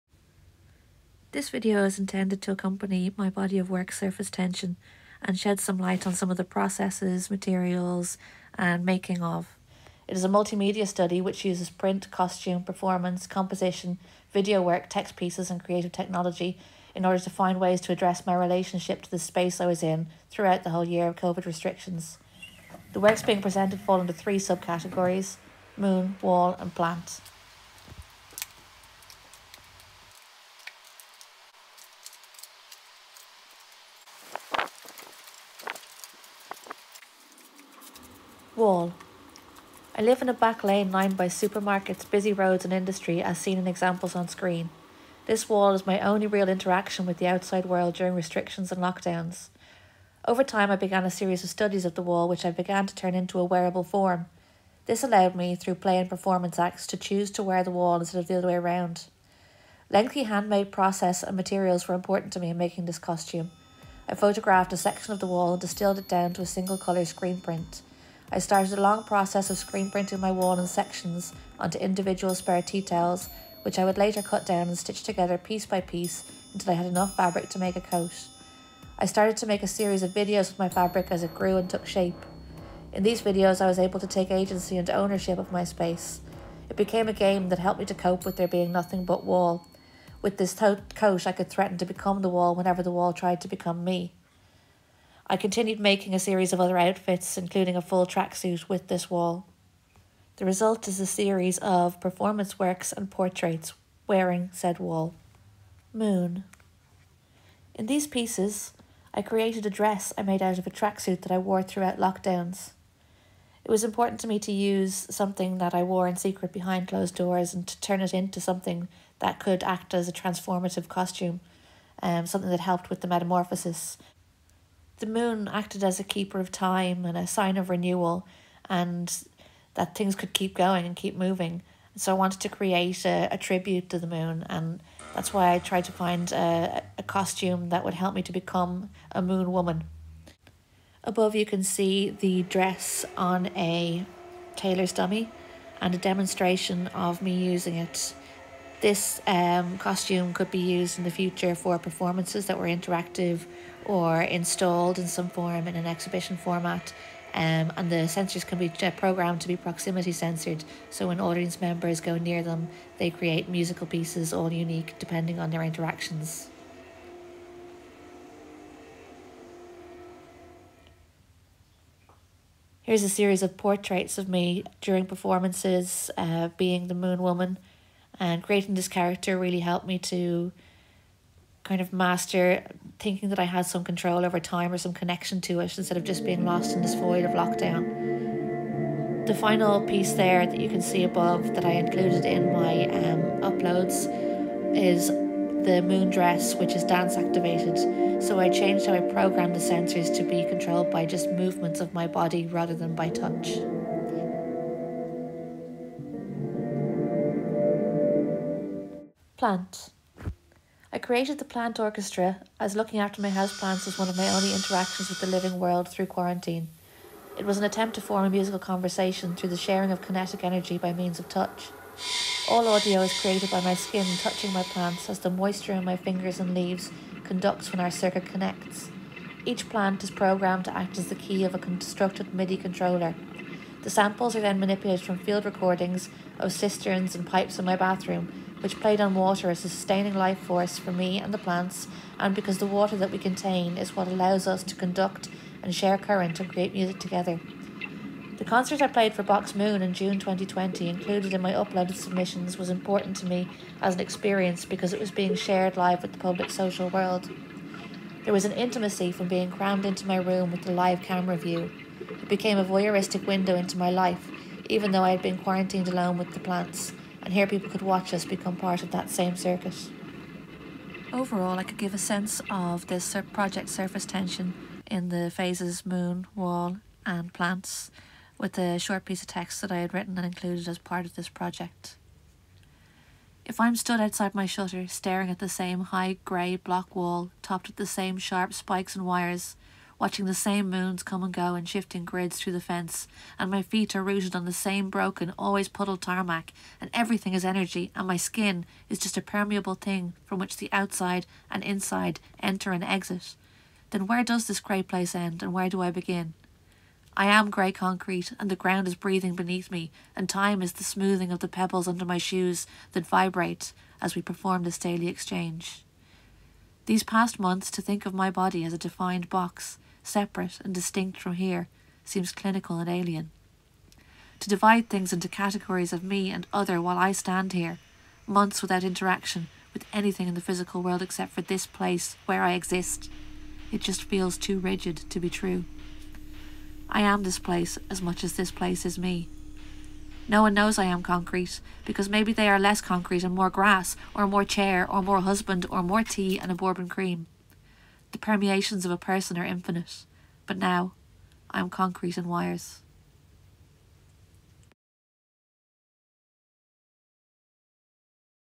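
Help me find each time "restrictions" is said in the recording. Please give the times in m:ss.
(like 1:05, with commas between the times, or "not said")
0:21, 0:48.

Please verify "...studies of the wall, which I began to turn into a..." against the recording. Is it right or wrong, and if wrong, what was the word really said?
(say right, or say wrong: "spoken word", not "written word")
right.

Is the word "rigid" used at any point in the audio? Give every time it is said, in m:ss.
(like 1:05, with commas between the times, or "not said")
5:34.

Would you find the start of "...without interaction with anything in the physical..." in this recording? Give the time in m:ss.
5:28.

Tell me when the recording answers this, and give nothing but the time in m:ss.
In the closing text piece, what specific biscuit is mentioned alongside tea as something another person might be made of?
5:46.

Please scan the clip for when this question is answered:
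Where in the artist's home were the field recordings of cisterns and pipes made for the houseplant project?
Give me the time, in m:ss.
3:57.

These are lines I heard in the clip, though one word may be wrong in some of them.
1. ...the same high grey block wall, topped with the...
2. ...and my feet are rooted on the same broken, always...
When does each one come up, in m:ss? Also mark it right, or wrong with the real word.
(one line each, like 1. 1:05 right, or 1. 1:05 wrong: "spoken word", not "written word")
1. 4:45 right
2. 4:53 right.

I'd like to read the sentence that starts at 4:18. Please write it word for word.
There was an intimacy from being crammed into my room with the live camera view.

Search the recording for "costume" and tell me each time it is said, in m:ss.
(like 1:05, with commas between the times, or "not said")
0:12, 1:02, 2:00, 2:17, 2:29.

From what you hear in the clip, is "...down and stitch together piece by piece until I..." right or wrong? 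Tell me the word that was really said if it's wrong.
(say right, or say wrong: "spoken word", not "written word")
right.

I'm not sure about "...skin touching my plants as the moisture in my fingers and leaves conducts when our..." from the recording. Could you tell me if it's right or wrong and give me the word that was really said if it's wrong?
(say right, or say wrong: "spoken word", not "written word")
right.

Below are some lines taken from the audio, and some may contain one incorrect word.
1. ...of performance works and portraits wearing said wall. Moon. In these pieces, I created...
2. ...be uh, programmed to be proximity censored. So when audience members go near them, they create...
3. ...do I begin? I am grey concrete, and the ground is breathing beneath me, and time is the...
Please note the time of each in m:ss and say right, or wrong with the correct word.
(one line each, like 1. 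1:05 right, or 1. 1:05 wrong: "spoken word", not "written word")
1. 1:41 right
2. 2:38 right
3. 5:05 right.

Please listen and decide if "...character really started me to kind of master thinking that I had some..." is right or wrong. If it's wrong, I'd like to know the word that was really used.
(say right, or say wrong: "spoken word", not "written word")
wrong: "helped", not "started".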